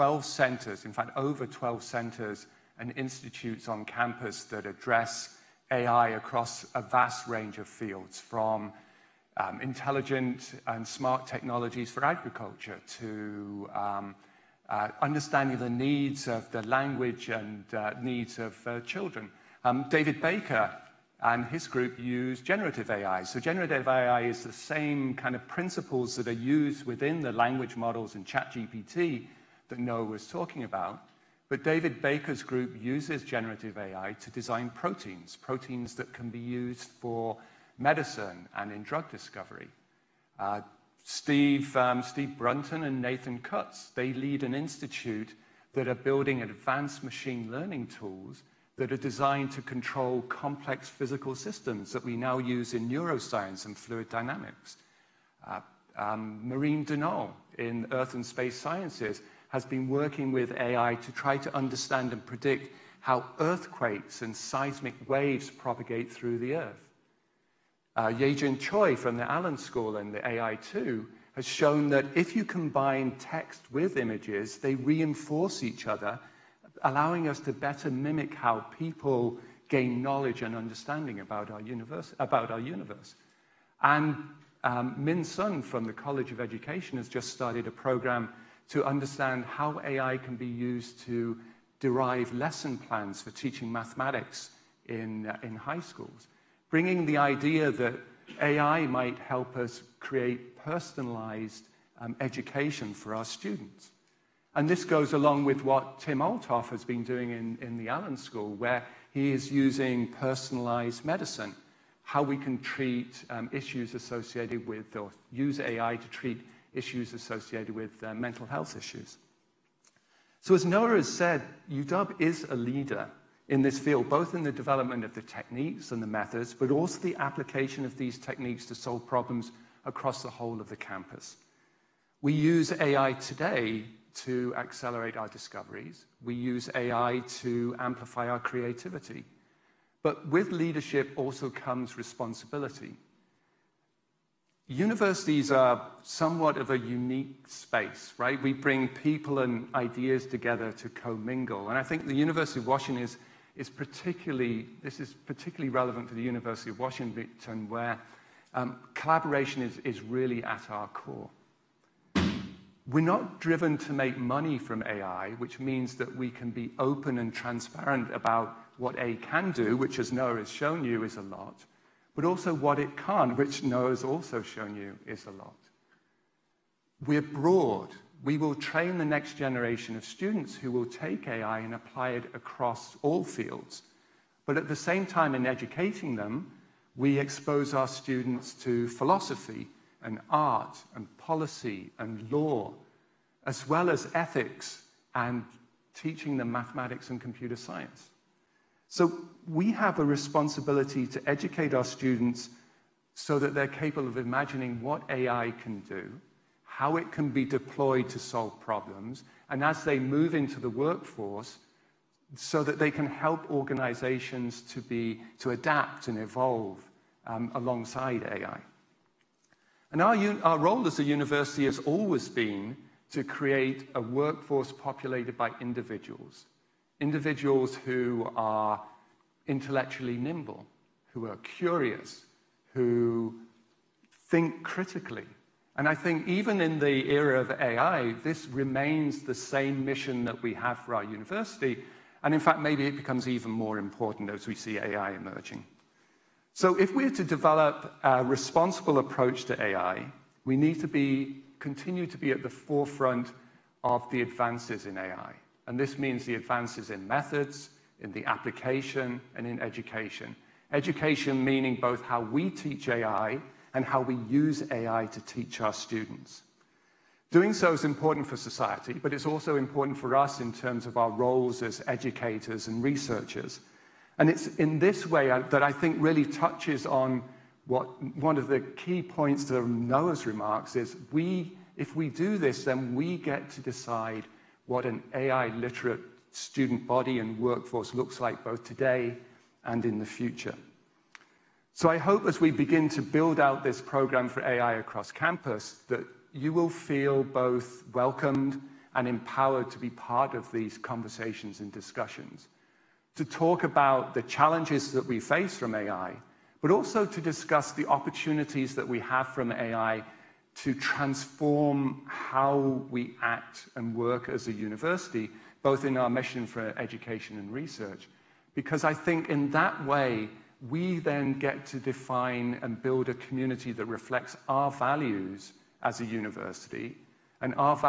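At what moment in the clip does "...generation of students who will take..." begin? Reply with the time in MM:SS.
02:59.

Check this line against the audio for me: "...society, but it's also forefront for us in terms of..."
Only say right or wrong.
wrong.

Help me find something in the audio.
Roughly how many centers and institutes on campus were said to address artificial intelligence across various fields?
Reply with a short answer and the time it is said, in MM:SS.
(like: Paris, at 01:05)
over 12, at 00:01.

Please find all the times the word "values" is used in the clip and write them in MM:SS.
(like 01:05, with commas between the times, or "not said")
05:24.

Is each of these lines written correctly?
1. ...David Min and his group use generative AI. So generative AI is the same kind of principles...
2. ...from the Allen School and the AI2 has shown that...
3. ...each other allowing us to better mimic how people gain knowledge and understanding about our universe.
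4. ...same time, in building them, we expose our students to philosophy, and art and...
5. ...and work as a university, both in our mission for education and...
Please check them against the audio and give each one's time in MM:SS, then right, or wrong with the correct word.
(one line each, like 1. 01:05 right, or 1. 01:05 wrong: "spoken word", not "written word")
1. 00:19 wrong: "Baker", not "Min"
2. 01:08 right
3. 01:15 right
4. 03:04 wrong: "educating", not "building"
5. 05:13 right.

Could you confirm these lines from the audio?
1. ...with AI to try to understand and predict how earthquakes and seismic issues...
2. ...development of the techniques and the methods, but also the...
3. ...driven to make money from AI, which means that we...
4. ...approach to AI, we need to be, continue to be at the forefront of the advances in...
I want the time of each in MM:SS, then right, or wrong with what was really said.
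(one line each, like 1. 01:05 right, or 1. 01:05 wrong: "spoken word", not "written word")
1. 01:00 wrong: "waves", not "issues"
2. 02:04 right
3. 02:43 right
4. 04:08 right.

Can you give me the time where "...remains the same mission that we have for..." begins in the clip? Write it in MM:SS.
03:58.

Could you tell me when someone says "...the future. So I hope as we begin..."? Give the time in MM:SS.
04:49.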